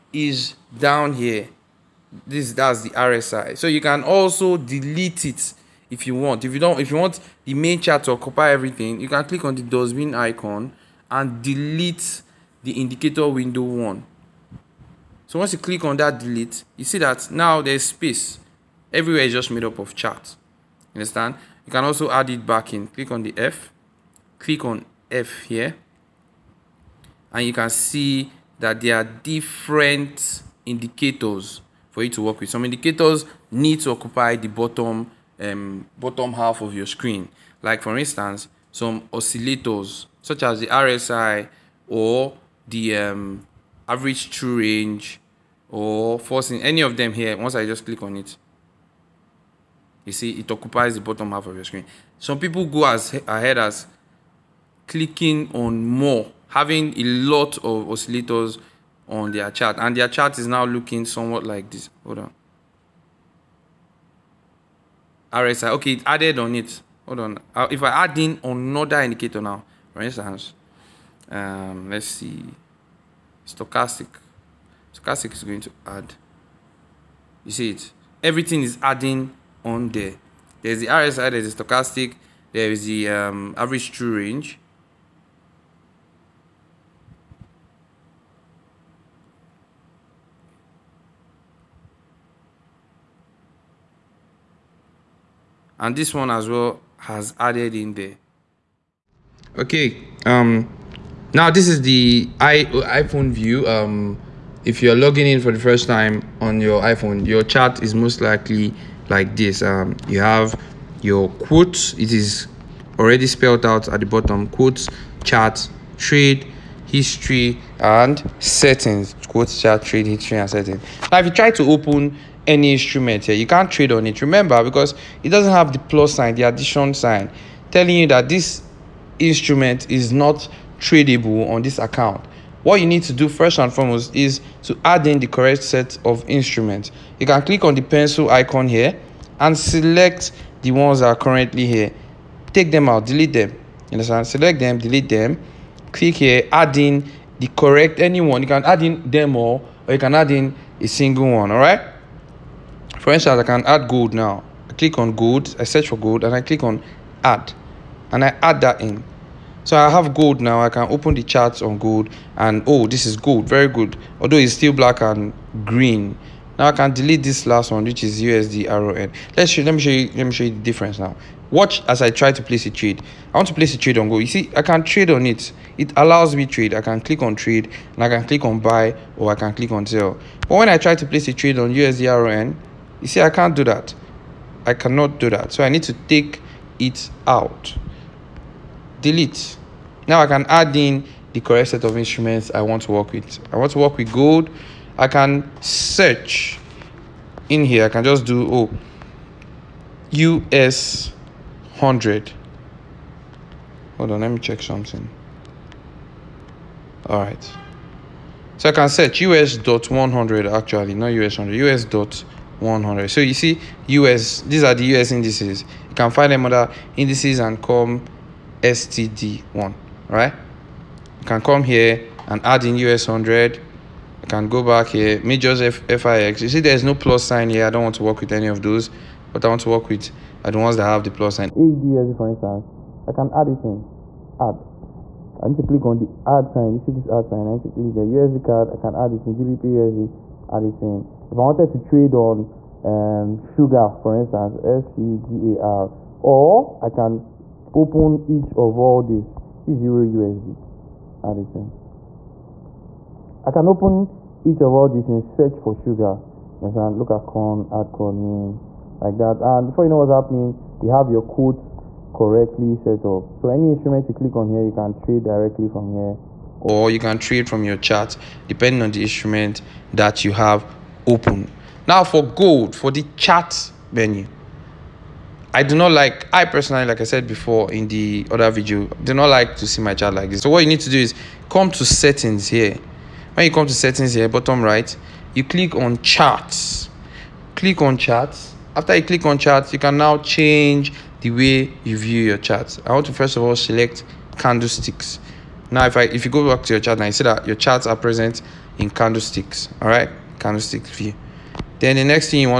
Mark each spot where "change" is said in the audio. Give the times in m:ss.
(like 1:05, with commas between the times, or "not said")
4:50.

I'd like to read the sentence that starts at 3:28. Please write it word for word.
So I can search US dot 100 actually, not US 100, US dot 100.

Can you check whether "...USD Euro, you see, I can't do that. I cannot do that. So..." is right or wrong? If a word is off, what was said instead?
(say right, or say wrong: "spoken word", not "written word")
wrong: "RON", not "Euro".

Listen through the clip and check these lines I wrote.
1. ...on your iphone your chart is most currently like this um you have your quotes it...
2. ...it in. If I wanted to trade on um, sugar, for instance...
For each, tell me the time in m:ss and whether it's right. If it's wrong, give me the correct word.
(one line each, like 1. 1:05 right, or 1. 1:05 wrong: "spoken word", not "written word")
1. 1:46 wrong: "likely", not "currently"
2. 4:00 right.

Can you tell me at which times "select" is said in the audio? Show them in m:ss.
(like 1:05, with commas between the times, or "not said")
2:19, 2:24, 4:53.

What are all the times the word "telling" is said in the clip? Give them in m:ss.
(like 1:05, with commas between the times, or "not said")
2:07.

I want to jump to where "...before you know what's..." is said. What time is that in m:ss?
4:19.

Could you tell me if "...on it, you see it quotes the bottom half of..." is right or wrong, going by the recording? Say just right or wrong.
wrong.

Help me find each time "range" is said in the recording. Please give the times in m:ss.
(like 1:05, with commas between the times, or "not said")
0:44, 1:24.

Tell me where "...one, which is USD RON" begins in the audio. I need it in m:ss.
2:47.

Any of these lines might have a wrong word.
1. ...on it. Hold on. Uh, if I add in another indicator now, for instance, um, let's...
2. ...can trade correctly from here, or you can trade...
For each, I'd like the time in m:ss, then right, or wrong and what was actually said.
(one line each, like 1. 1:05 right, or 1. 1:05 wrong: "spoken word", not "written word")
1. 1:06 right
2. 4:24 wrong: "directly", not "correctly".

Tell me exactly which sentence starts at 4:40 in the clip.
So what you need to do is come to settings here.